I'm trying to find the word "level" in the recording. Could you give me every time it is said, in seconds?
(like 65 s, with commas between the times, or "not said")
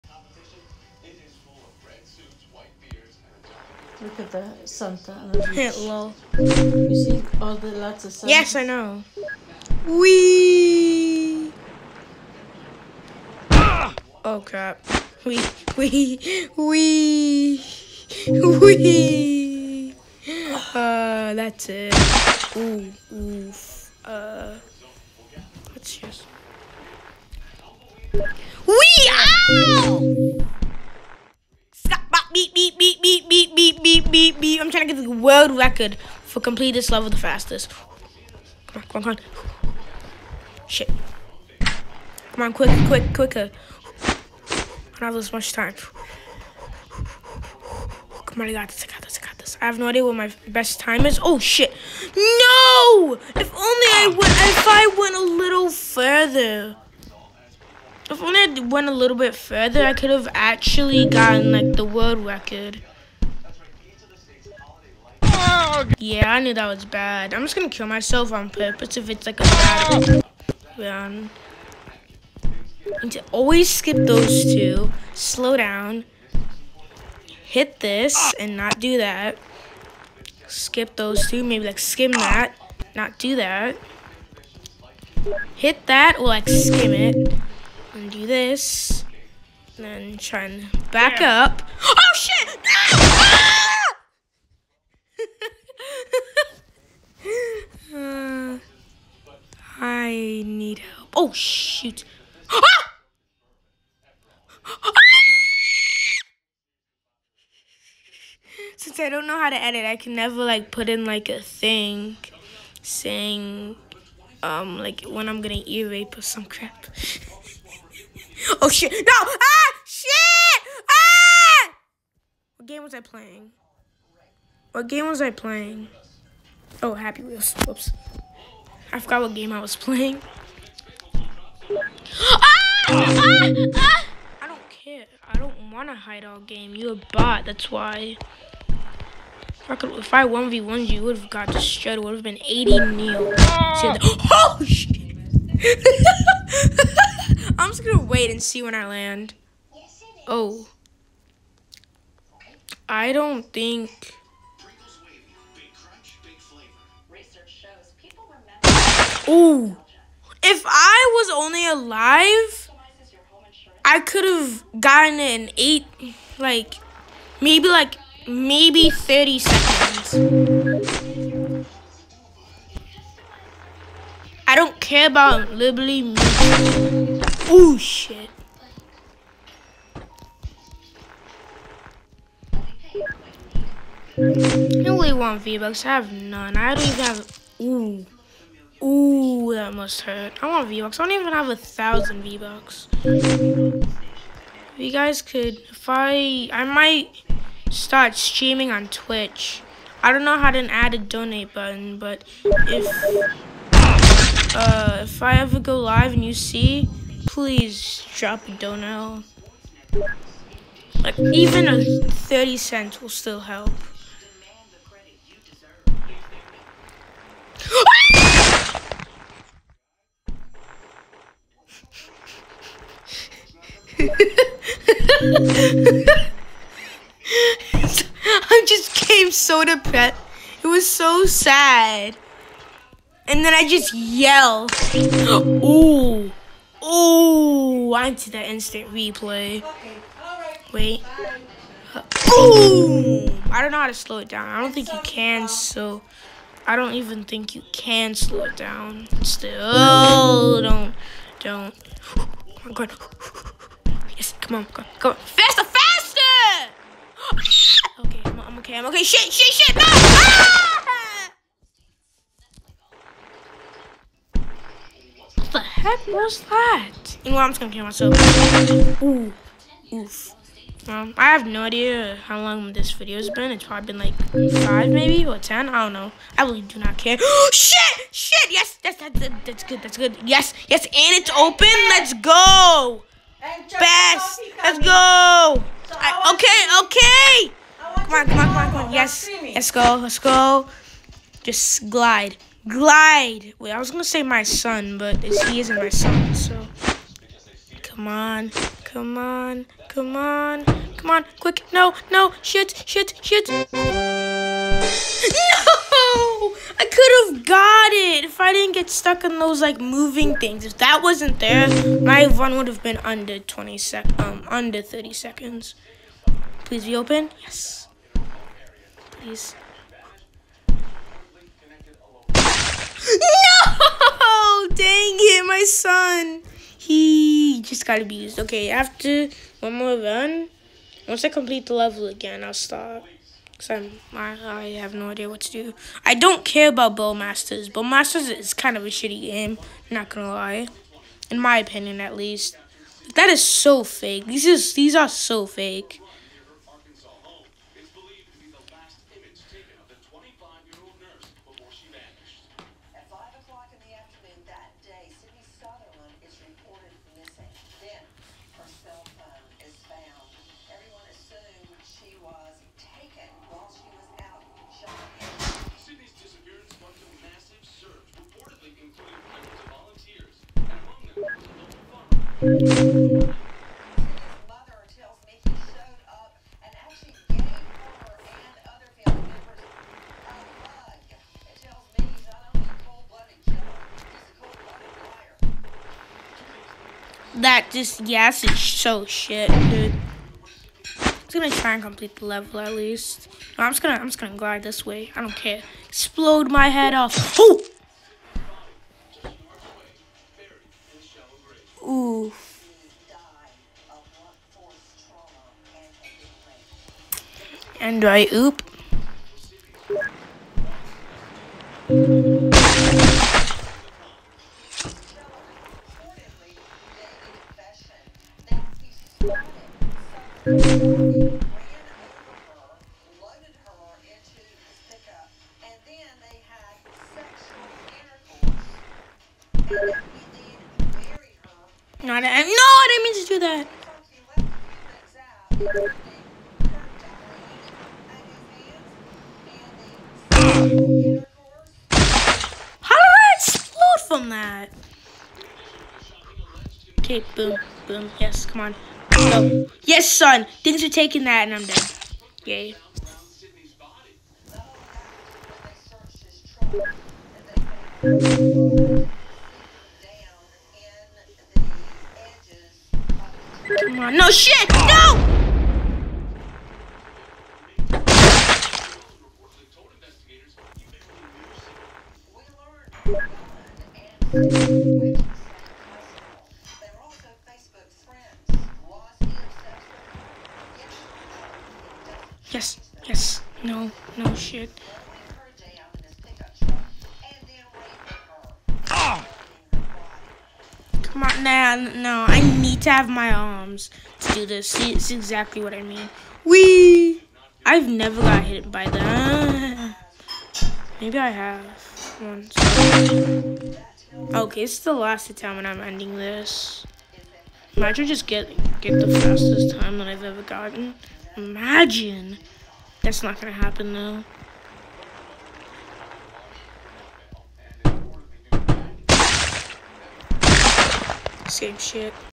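36 s, 331 s, 392 s.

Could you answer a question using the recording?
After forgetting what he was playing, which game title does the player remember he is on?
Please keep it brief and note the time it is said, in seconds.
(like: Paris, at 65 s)
Happy Wheels, at 126 s.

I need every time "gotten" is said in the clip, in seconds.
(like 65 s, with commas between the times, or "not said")
61 s, 164 s, 510 s.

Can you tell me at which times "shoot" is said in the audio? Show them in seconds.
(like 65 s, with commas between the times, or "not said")
101 s.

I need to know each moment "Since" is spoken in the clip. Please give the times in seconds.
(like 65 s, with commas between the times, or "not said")
108 s.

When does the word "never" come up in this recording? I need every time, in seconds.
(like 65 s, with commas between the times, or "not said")
110 s, 497 s.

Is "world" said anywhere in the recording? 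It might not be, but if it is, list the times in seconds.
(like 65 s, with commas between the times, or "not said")
35 s, 61 s.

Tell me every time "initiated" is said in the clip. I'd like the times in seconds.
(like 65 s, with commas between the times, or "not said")
not said.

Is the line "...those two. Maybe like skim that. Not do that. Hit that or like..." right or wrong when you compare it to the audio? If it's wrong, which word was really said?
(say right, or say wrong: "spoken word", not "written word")
right.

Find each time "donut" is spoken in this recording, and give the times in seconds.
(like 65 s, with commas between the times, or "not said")
208 s.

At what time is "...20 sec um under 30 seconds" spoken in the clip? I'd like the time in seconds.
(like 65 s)
313 s.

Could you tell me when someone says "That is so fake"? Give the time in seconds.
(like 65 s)
343 s.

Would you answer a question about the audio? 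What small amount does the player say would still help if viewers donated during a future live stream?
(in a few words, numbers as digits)
30 cents.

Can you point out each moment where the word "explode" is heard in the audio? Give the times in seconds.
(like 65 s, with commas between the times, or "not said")
395 s, 443 s.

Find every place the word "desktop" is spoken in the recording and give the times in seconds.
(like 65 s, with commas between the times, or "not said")
not said.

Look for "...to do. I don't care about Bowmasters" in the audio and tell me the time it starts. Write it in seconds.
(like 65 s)
335 s.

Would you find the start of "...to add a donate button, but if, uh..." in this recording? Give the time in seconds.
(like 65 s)
200 s.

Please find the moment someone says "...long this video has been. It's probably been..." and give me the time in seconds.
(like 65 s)
272 s.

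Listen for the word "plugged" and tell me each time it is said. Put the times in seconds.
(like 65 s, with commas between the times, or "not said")
not said.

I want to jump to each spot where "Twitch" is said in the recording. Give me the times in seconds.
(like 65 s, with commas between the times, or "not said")
198 s.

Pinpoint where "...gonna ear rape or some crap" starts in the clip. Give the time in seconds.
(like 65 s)
115 s.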